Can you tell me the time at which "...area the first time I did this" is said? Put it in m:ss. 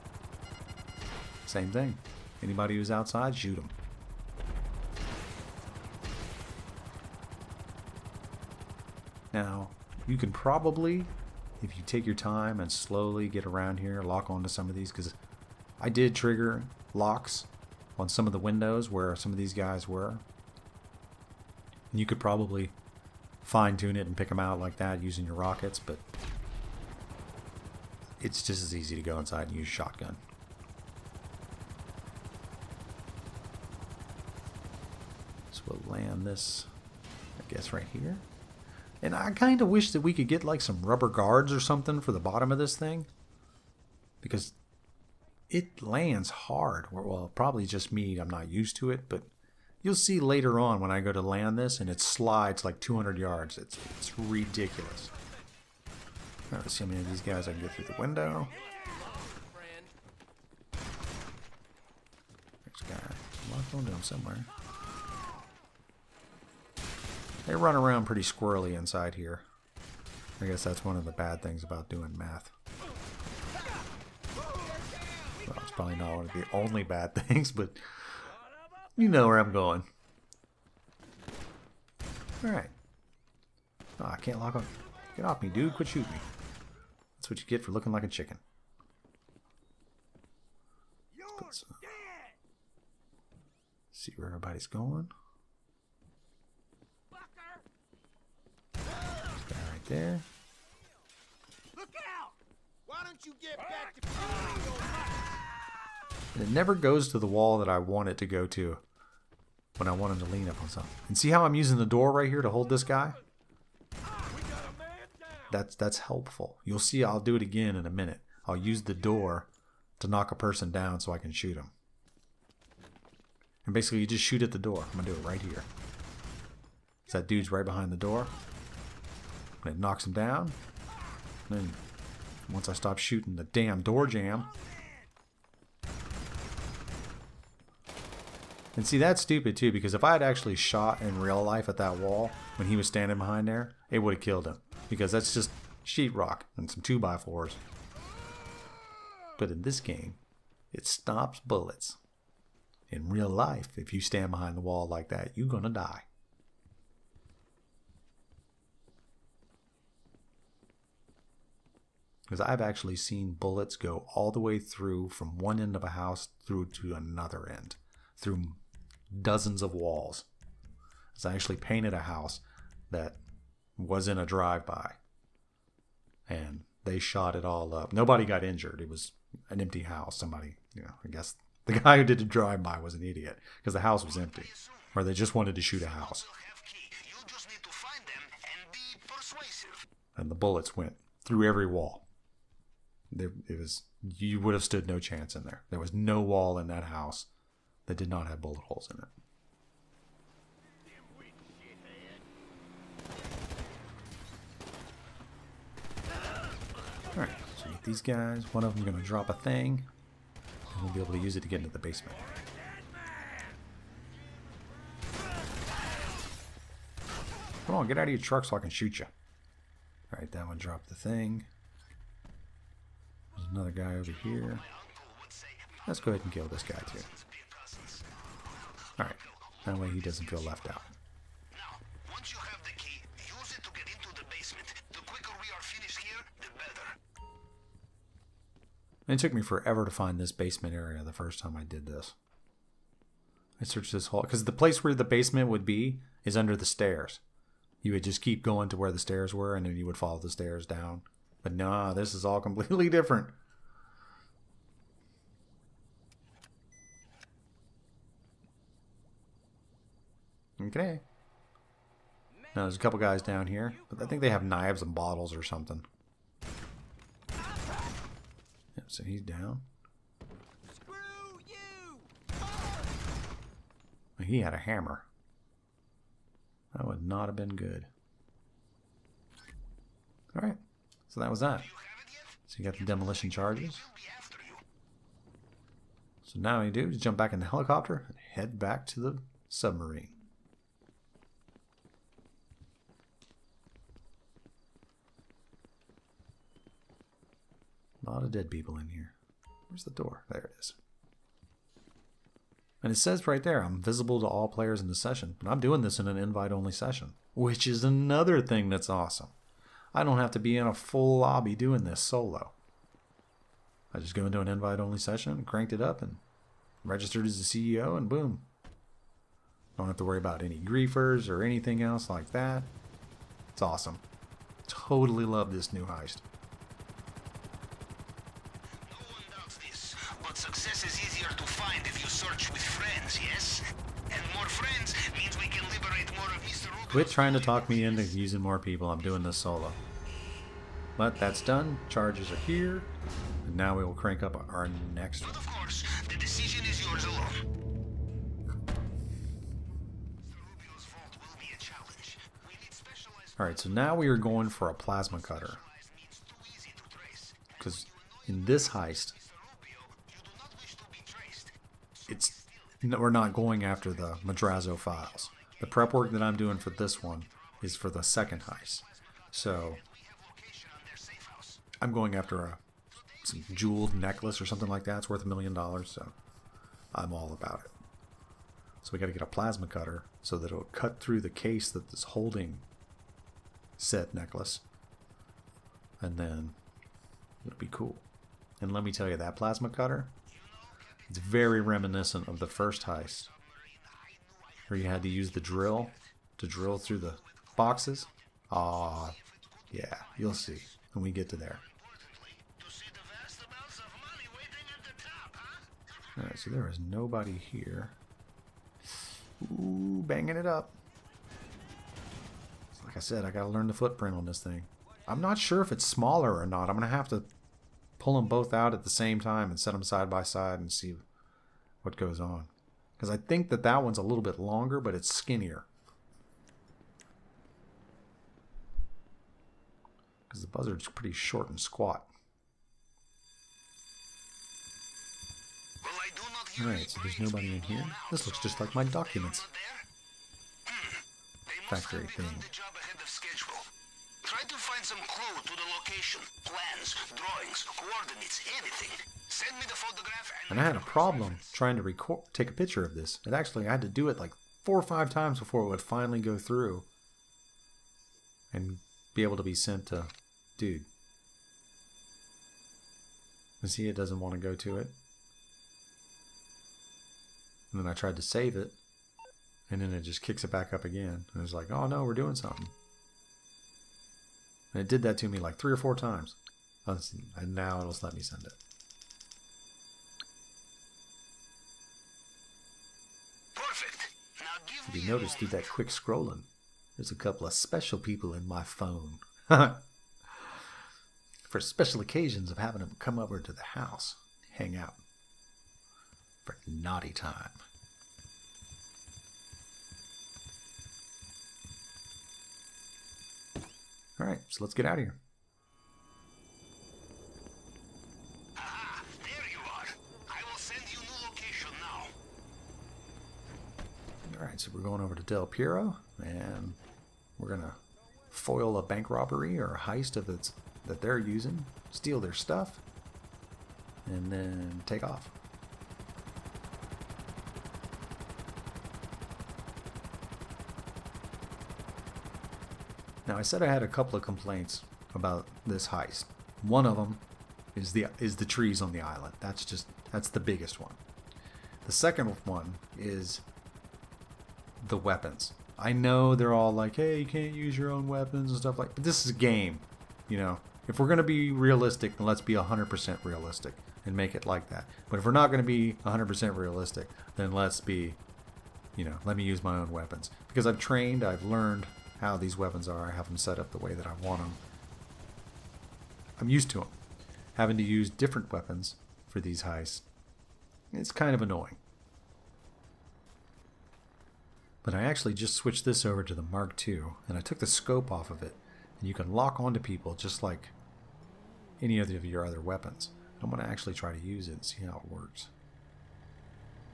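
4:00.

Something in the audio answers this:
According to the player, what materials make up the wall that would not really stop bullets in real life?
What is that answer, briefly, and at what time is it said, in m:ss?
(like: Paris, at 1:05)
sheetrock and 2x4s, at 2:25.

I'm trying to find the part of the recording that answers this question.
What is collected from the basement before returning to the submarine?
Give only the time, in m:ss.
4:42.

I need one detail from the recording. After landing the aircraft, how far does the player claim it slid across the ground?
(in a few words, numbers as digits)
200 yards.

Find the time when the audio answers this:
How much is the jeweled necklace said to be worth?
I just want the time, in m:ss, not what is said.
6:15.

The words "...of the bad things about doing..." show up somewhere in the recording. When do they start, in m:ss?
1:10.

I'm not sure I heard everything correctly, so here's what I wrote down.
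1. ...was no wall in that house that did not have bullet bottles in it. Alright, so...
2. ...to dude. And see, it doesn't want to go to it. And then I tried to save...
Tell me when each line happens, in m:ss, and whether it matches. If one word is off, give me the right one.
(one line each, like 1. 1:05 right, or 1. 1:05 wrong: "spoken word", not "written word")
1. 3:15 wrong: "holes", not "bottles"
2. 7:39 right.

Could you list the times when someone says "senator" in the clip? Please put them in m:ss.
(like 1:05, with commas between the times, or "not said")
not said.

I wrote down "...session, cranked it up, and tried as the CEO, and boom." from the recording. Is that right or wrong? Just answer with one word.
wrong.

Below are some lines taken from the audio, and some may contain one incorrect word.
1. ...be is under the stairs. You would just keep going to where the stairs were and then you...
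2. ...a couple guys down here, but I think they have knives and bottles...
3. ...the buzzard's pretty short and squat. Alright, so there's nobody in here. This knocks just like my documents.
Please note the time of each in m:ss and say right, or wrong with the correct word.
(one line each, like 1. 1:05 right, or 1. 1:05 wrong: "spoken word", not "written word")
1. 4:05 right
2. 4:22 right
3. 7:10 wrong: "looks", not "knocks".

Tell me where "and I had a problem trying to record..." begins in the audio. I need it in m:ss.
7:30.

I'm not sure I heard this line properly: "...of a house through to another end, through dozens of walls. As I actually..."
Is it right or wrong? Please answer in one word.
right.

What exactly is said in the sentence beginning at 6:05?
The prep work that I'm doing for this one is for the second heist.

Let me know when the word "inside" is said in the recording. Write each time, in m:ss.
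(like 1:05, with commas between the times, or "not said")
0:29, 1:08.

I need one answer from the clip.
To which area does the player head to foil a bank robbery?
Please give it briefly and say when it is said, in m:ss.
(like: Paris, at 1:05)
Del Perro, at 8:35.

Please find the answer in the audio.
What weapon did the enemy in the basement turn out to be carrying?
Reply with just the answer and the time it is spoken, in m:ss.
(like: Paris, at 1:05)
a hammer, at 4:34.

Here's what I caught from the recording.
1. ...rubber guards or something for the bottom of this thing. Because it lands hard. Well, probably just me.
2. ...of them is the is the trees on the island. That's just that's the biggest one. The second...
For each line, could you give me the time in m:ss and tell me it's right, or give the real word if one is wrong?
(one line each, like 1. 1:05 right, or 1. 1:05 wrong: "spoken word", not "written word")
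1. 0:40 right
2. 8:56 right.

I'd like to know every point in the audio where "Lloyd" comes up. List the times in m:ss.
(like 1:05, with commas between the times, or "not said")
not said.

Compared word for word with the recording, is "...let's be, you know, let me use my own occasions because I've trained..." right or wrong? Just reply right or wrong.
wrong.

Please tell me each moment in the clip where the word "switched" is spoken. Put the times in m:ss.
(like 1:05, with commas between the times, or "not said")
9:35.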